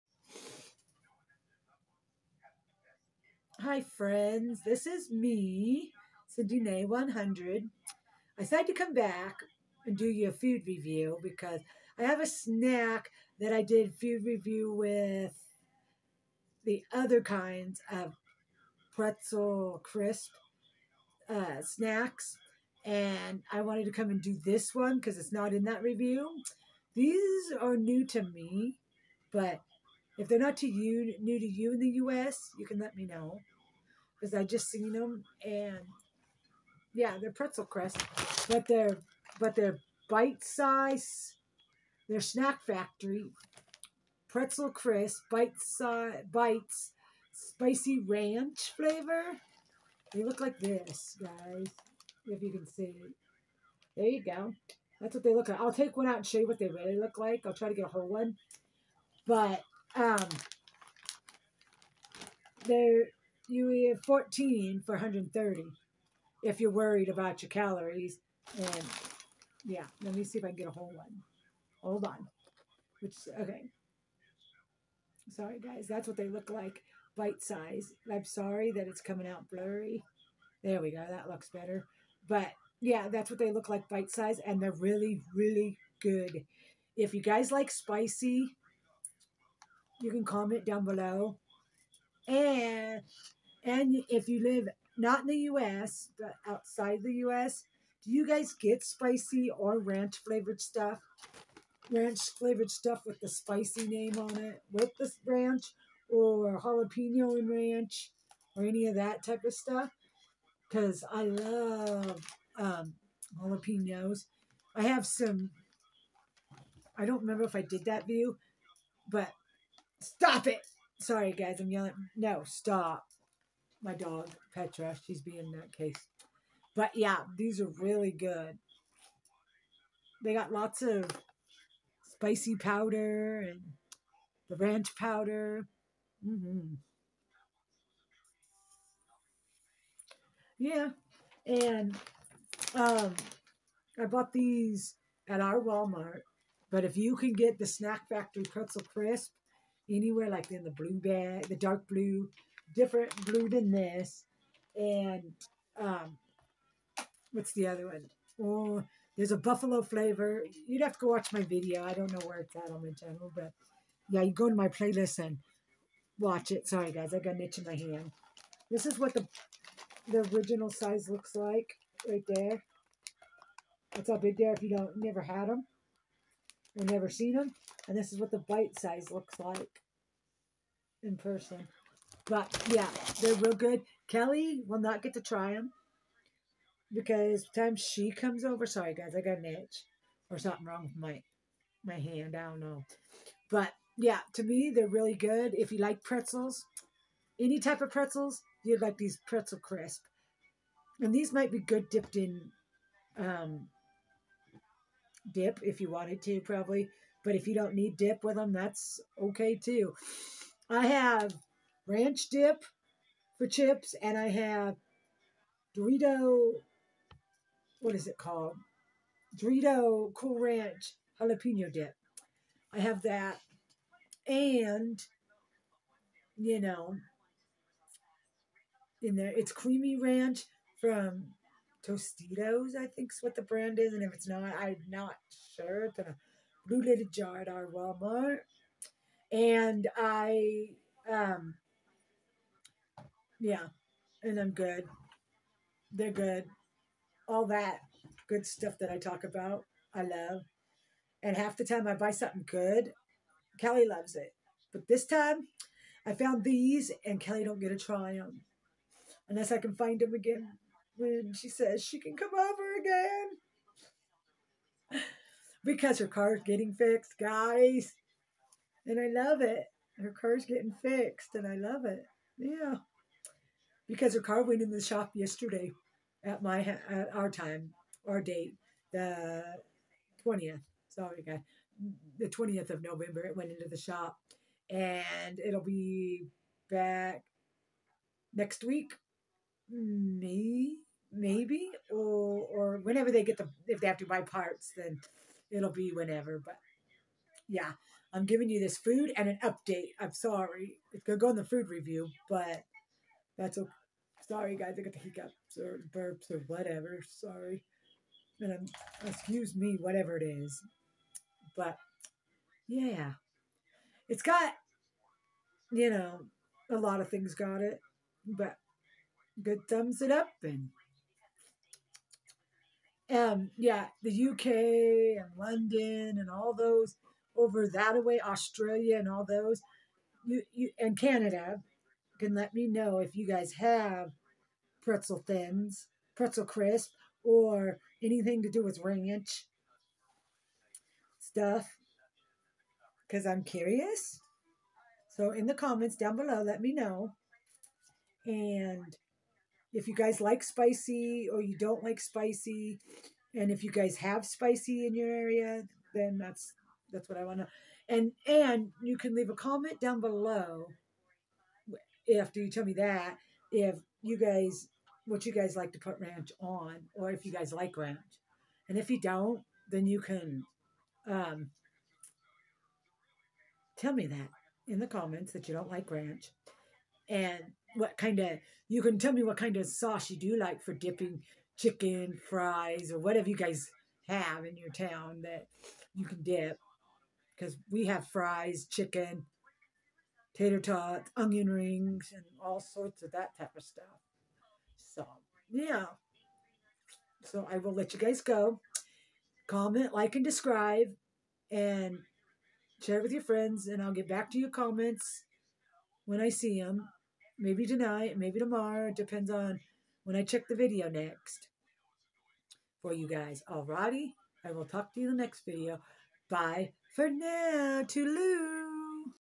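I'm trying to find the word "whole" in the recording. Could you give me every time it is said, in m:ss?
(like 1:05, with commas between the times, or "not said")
0:57, 1:10.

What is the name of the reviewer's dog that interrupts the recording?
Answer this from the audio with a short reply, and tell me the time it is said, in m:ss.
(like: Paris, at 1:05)
Petra, at 2:04.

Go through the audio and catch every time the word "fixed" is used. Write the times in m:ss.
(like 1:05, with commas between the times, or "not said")
4:26, 4:30.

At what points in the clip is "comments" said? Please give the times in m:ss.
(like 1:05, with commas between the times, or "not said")
1:30, 5:45, 5:59, 6:14, 6:39, 6:44.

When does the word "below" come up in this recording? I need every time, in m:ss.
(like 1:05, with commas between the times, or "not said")
1:30, 5:46, 6:00.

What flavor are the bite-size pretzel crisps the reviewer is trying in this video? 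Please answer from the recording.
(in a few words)
Spicy ranch.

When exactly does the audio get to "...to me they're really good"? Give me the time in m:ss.
3:14.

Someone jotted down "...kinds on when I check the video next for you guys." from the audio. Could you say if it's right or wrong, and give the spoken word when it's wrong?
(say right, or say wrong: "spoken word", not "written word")
wrong: "depends", not "kinds".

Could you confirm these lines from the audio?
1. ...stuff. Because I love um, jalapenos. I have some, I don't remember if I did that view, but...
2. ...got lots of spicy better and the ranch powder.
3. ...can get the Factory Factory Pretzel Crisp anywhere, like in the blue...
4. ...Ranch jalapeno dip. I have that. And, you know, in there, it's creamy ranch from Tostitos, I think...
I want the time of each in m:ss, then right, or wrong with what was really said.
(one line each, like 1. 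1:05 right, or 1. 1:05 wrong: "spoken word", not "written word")
1. 1:49 right
2. 2:10 wrong: "powder", not "better"
3. 2:27 wrong: "Snack", not "Factory"
4. 3:40 right.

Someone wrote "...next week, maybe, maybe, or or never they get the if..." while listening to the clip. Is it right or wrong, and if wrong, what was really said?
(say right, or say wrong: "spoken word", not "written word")
wrong: "whenever", not "never".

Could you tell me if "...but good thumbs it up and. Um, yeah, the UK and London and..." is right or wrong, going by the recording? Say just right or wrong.
right.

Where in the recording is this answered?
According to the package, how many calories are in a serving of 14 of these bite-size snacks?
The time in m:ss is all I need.
1:04.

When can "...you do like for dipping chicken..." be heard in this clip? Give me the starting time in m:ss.
6:20.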